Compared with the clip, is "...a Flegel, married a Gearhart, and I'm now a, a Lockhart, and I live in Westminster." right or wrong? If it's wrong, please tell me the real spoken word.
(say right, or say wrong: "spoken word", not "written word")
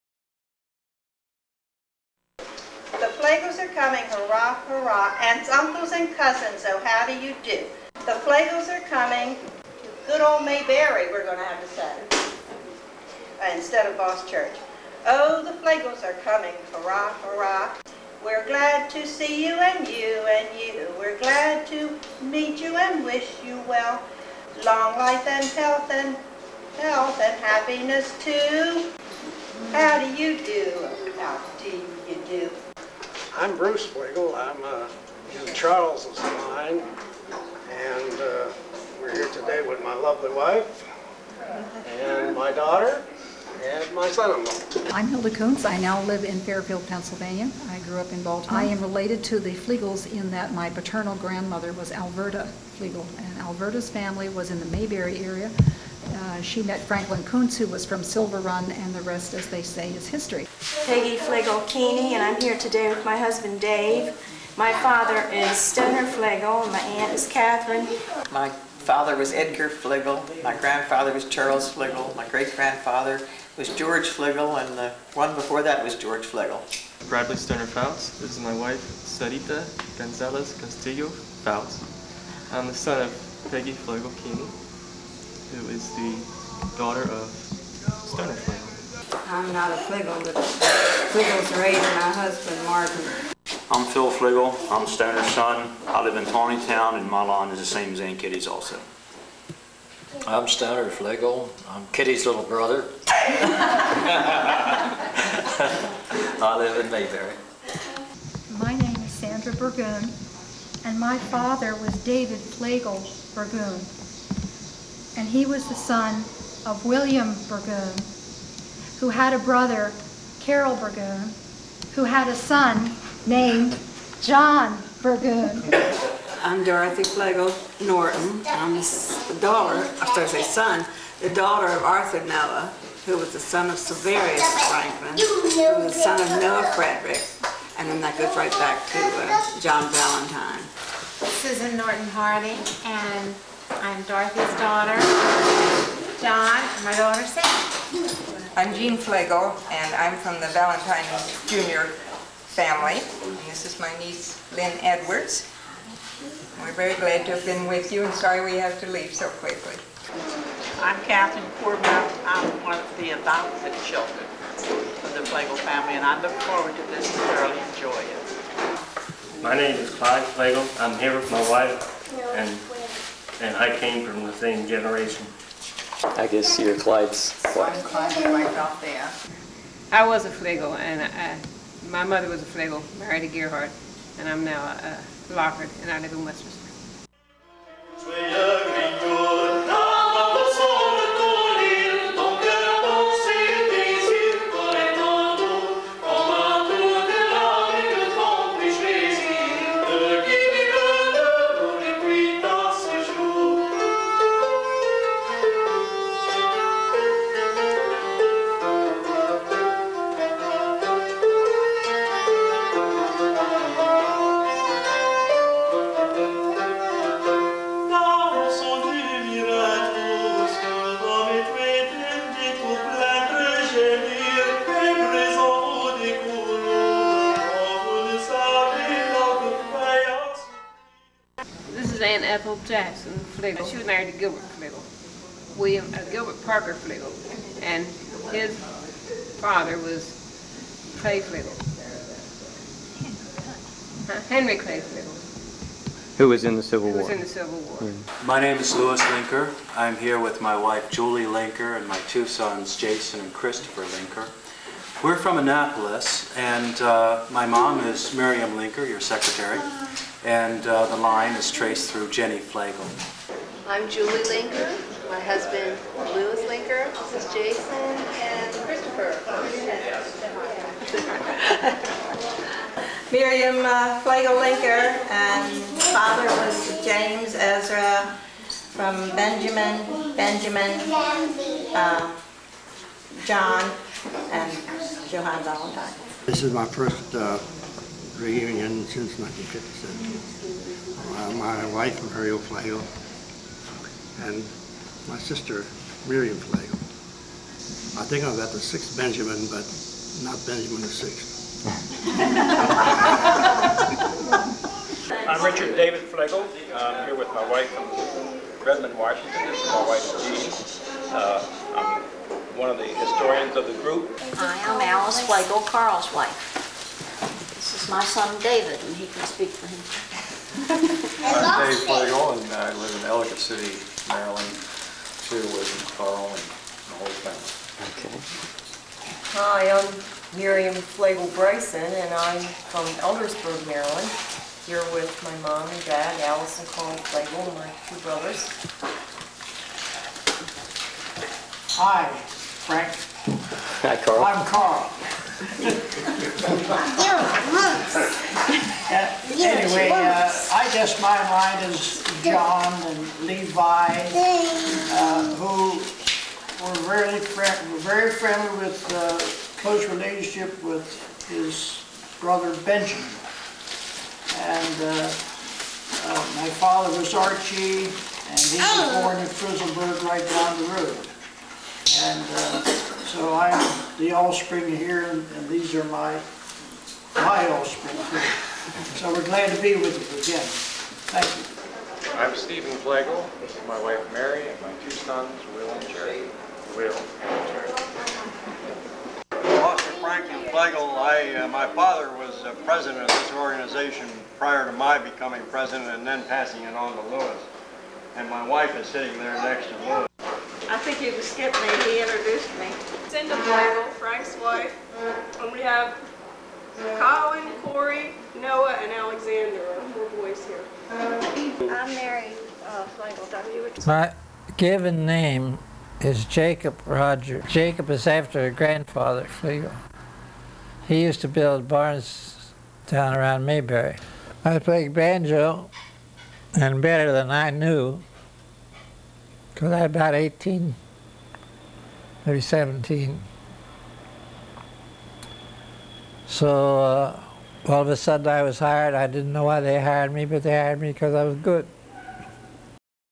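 right.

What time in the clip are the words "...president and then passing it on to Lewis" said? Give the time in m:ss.
6:35.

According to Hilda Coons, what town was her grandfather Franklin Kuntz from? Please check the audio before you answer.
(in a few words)
Silver Run.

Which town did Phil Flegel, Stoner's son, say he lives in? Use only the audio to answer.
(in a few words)
Taneytown.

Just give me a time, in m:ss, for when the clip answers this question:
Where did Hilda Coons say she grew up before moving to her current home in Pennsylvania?
0:48.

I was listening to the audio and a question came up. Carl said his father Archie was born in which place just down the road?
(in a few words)
Frizzleburg.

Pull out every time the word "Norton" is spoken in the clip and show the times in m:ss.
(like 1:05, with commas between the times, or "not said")
2:07, 2:21.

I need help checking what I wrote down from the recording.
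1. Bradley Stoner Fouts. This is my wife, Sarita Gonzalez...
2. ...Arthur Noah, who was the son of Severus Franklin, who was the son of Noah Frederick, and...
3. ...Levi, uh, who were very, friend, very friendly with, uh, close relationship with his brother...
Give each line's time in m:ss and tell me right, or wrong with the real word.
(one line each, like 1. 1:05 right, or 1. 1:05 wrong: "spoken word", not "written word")
1. 1:17 right
2. 2:11 right
3. 5:53 right.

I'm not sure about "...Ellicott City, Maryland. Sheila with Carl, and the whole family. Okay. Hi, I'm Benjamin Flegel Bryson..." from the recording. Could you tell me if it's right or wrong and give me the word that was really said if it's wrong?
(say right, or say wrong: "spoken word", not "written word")
wrong: "Miriam", not "Benjamin".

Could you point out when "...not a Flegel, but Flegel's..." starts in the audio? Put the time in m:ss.
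1:29.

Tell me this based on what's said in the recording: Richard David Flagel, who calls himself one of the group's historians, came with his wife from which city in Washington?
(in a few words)
Redmond.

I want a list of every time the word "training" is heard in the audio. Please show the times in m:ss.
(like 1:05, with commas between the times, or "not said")
not said.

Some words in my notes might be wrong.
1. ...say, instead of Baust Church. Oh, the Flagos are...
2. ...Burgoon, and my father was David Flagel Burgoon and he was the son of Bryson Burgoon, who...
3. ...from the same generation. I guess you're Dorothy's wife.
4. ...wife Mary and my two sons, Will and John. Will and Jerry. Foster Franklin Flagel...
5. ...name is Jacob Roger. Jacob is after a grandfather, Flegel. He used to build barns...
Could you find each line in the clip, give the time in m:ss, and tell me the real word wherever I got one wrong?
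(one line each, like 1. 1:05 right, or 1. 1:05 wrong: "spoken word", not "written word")
1. 0:11 right
2. 1:49 wrong: "William", not "Bryson"
3. 2:54 wrong: "Clyde", not "Dorothy"
4. 6:23 wrong: "Jerry", not "John"
5. 6:55 right.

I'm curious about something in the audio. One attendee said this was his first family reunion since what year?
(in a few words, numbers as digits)
1957.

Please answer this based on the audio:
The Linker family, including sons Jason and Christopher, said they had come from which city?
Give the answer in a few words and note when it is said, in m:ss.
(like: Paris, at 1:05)
Annapolis, at 4:15.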